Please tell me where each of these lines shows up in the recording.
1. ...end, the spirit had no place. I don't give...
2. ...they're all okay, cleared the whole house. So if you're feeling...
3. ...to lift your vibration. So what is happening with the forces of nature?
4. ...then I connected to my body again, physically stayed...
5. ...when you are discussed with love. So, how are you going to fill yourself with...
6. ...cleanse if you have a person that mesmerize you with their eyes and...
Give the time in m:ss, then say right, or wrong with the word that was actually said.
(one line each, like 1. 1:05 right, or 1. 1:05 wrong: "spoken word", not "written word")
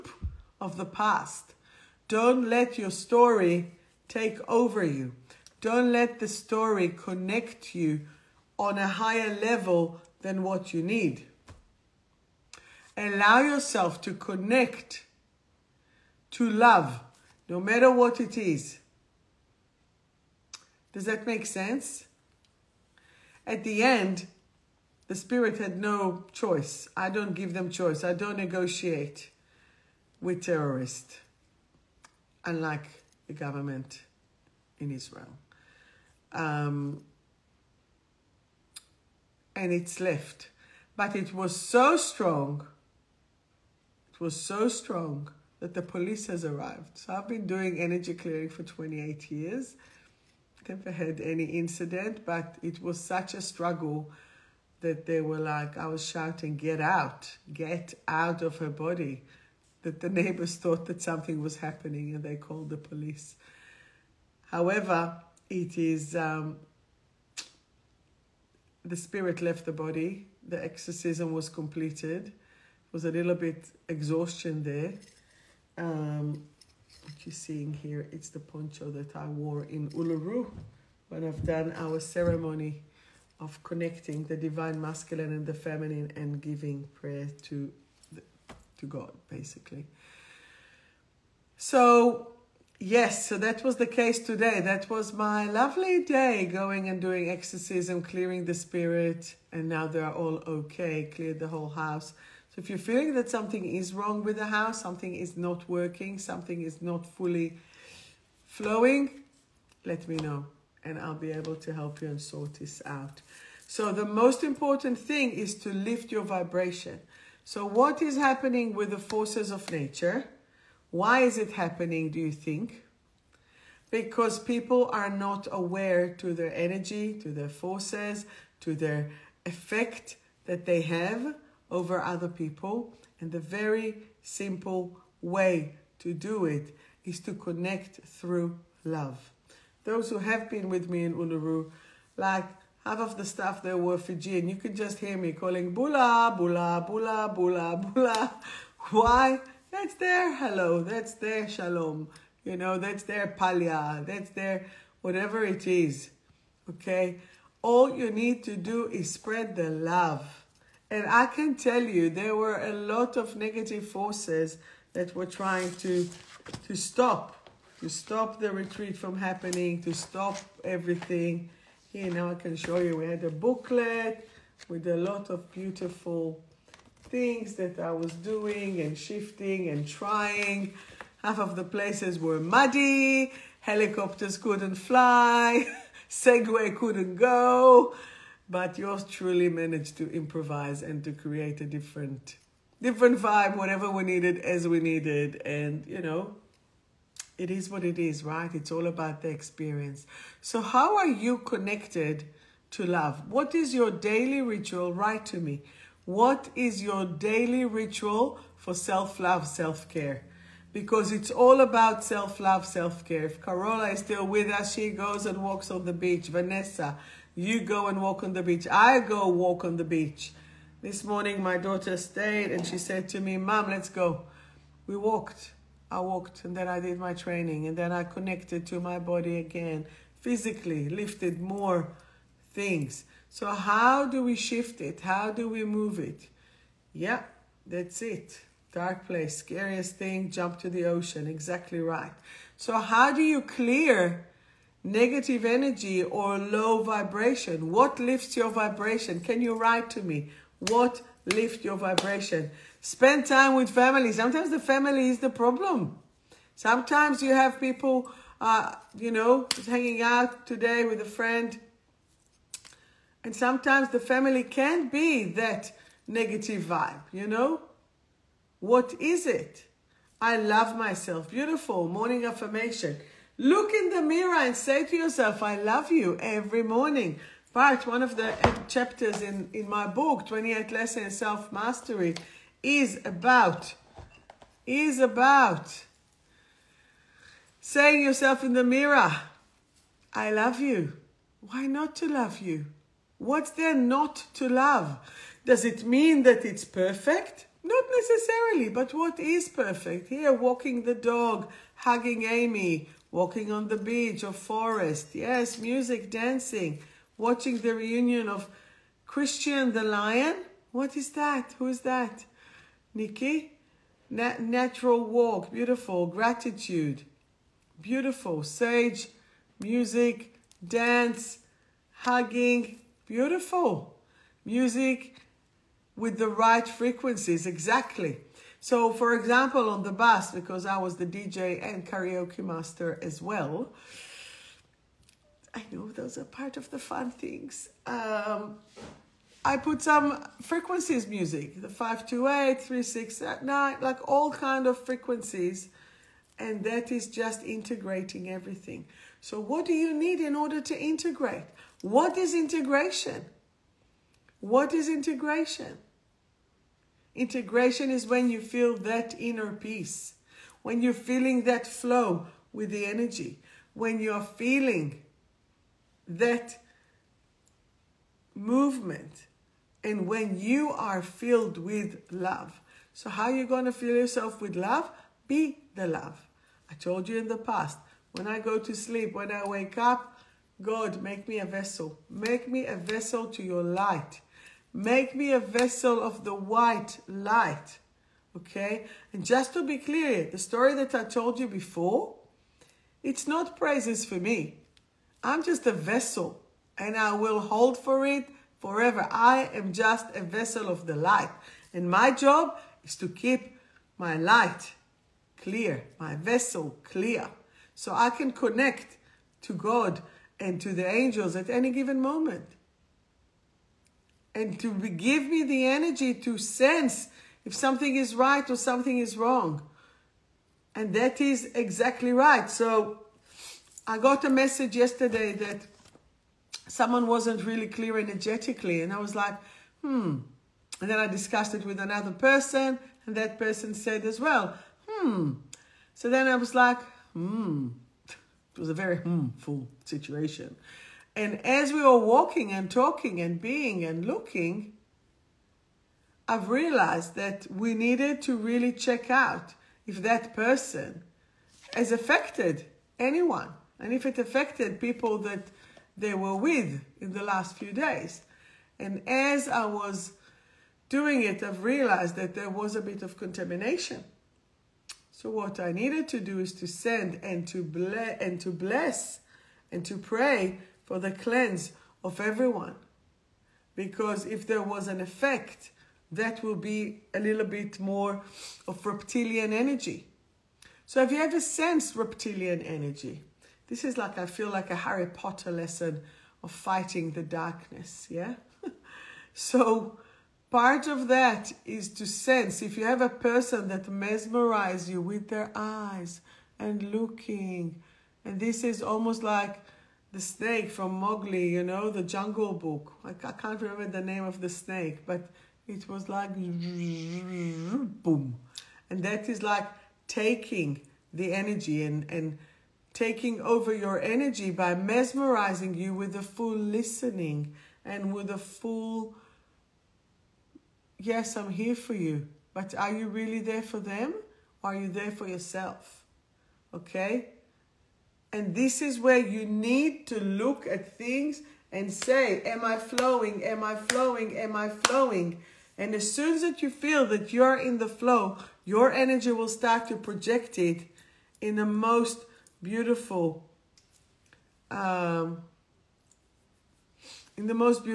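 1. 0:23 wrong: "choice", not "place"
2. 1:39 right
3. 1:55 right
4. 3:47 wrong: "lifted", not "stayed"
5. 6:10 wrong: "filled", not "discussed"
6. 8:12 wrong: "sense", not "cleanse".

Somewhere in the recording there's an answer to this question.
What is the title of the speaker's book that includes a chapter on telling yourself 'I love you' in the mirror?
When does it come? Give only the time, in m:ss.
4:40.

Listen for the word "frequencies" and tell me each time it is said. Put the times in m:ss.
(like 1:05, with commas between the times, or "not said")
5:26, 5:40, 5:44.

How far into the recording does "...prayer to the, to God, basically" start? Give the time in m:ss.
1:26.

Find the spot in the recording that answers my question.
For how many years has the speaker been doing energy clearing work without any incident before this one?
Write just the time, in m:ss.
0:48.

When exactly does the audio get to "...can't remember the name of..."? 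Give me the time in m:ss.
8:23.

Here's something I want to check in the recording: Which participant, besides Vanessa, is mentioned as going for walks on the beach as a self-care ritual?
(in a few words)
Carola.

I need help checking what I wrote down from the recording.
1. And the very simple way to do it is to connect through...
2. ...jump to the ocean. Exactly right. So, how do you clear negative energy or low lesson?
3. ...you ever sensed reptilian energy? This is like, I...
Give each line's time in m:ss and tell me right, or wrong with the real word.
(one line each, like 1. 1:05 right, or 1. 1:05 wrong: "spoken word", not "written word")
1. 2:13 right
2. 4:00 wrong: "vibration", not "lesson"
3. 8:01 right.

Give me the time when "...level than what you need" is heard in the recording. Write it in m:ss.
0:09.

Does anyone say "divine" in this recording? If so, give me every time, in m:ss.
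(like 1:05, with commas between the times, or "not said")
1:24.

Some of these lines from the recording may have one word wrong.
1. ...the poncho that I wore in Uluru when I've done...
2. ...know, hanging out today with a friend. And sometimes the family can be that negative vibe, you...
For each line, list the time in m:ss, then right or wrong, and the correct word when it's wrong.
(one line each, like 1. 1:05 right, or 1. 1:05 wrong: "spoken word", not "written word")
1. 1:18 right
2. 4:19 right.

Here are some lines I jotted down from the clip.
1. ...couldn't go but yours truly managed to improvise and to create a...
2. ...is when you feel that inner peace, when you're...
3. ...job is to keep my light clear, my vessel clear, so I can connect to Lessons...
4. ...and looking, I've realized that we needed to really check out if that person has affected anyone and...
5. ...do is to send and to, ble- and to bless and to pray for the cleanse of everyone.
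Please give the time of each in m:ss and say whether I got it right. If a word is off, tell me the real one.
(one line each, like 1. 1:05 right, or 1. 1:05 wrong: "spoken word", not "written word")
1. 3:06 right
2. 5:57 right
3. 6:42 wrong: "God", not "Lessons"
4. 7:23 right
5. 7:46 right.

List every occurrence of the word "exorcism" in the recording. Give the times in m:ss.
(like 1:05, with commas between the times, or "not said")
1:10, 1:37.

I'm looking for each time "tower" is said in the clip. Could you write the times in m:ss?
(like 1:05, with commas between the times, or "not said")
not said.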